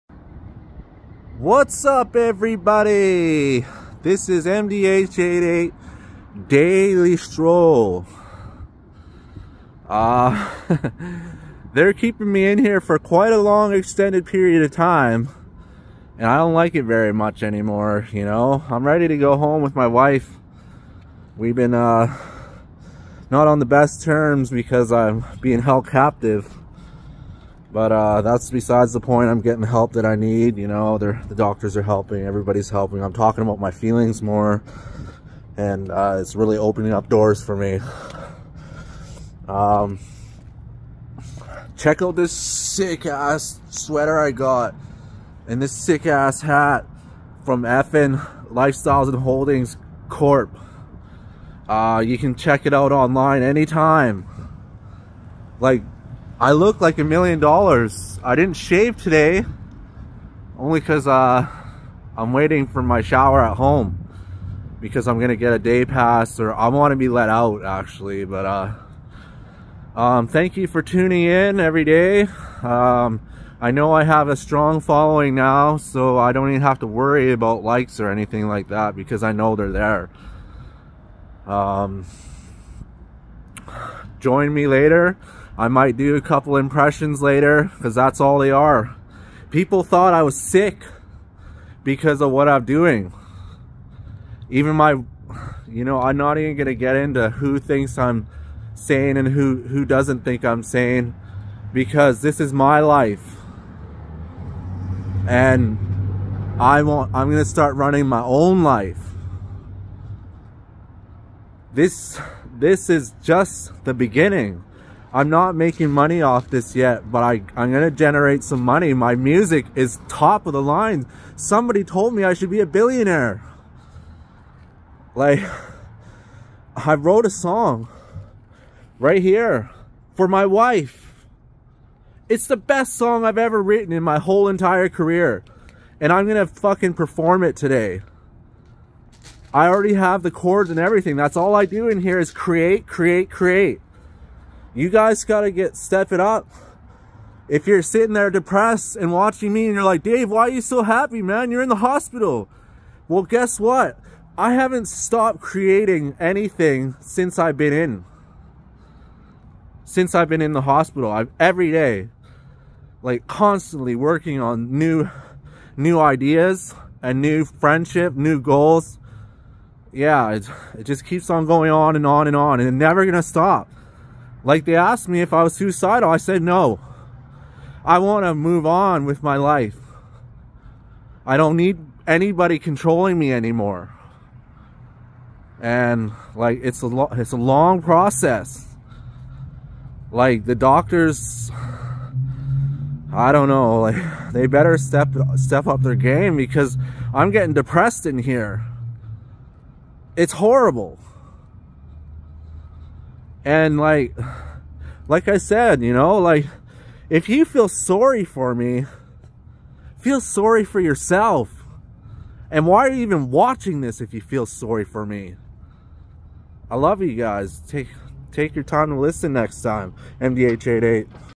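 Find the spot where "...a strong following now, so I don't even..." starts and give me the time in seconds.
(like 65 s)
74 s.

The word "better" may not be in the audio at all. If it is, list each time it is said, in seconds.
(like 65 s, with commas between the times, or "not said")
194 s.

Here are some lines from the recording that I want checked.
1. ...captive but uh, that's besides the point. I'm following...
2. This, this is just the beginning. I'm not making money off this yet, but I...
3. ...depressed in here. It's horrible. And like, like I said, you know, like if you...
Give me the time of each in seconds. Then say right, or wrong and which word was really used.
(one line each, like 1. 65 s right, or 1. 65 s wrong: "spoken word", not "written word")
1. 25 s wrong: "getting", not "following"
2. 111 s right
3. 197 s right.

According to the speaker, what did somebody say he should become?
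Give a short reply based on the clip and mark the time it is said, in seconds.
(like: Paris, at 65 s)
billionaire, at 122 s.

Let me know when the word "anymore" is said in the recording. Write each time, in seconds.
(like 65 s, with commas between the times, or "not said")
17 s, 183 s.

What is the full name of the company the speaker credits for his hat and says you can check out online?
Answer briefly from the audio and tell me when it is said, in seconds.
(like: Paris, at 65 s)
Effin Lifestyles and Holdings Corp, at 47 s.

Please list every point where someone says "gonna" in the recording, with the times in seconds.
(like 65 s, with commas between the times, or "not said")
65 s, 173 s.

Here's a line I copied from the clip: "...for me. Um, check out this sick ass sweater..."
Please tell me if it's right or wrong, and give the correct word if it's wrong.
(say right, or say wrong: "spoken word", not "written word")
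right.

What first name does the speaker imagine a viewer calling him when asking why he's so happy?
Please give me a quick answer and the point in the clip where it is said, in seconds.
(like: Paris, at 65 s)
Dave, at 150 s.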